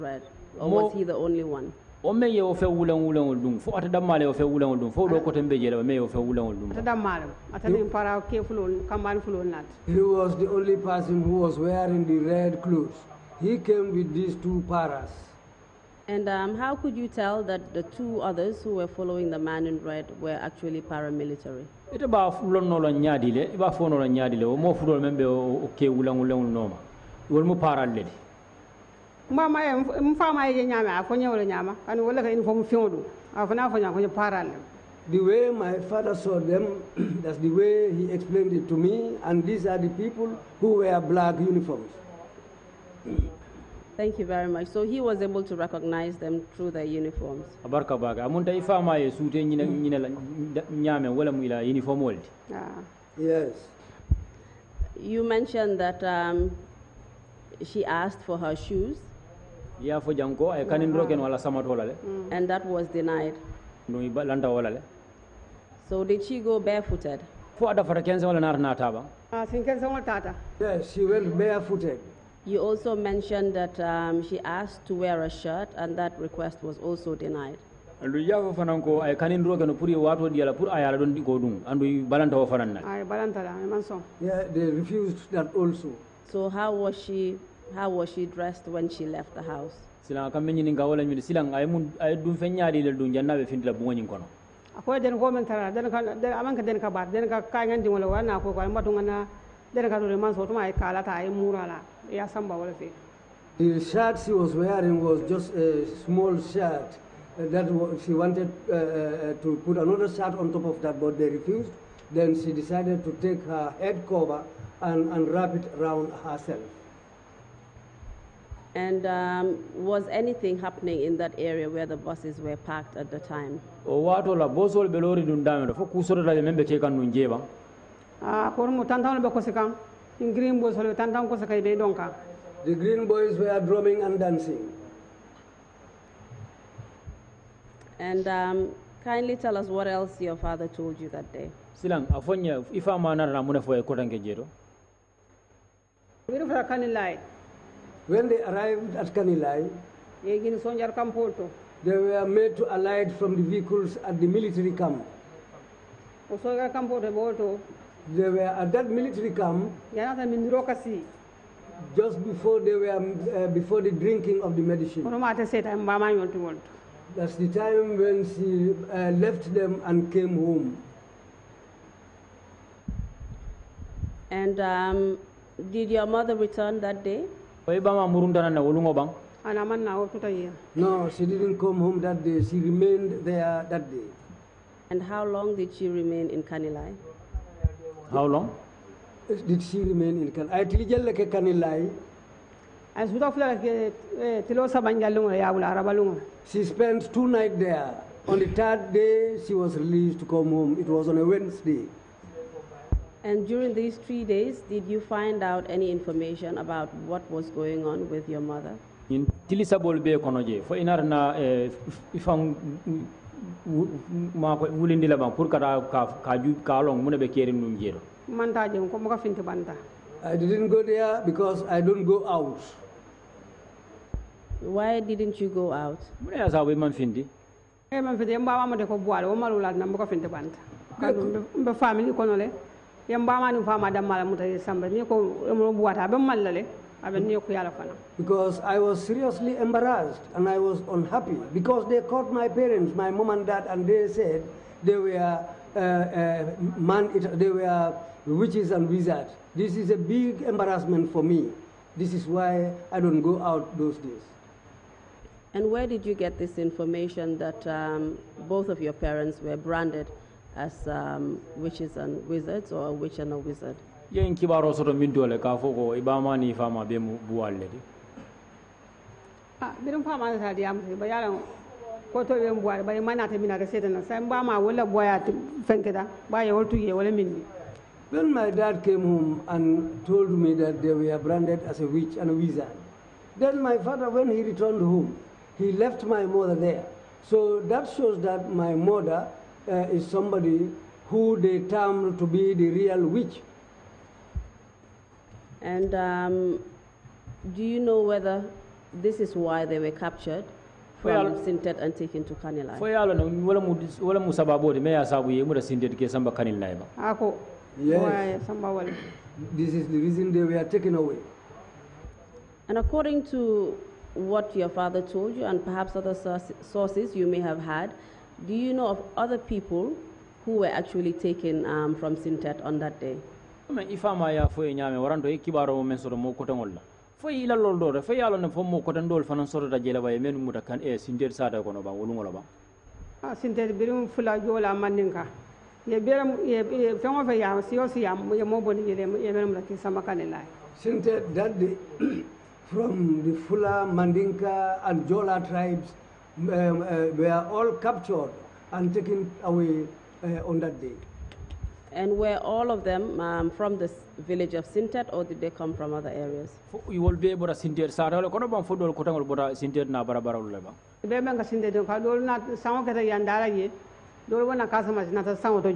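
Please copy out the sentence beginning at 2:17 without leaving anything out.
And um, kindly tell us what else your father told you that day.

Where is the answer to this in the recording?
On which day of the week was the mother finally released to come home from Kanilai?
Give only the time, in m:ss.
3:21.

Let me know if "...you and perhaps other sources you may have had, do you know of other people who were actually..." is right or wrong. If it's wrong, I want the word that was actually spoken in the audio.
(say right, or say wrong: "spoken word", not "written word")
right.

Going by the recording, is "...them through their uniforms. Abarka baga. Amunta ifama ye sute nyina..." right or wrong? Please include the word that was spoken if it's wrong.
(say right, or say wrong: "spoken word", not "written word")
right.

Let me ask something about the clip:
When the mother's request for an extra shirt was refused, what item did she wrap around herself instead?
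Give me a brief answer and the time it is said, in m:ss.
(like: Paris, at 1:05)
Her head cover, at 1:53.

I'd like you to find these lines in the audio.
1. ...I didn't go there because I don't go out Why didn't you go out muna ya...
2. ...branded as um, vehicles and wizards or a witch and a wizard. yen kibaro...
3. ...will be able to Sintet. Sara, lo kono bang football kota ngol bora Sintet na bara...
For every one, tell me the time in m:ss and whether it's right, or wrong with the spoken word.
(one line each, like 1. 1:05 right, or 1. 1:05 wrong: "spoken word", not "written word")
1. 3:40 right
2. 4:19 wrong: "witches", not "vehicles"
3. 5:57 right.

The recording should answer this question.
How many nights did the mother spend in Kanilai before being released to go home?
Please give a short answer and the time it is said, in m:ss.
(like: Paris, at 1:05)
2, at 3:17.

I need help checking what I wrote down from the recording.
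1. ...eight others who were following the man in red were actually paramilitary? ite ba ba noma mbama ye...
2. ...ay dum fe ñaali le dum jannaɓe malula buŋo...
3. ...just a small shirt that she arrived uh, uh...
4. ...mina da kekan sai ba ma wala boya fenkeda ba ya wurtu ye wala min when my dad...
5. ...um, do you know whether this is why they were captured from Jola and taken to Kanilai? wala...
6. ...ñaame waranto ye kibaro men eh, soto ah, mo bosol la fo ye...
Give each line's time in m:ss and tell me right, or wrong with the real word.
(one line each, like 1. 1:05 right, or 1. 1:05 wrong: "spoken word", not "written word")
1. 0:17 wrong: "two", not "eight"
2. 1:31 wrong: "findila", not "malula"
3. 1:45 wrong: "wanted", not "arrived"
4. 4:33 wrong: "setan", not "kekan"
5. 4:55 wrong: "Sintet", not "Jola"
6. 5:24 wrong: "koteŋol", not "bosol".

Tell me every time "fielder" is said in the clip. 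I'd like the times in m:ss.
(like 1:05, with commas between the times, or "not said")
not said.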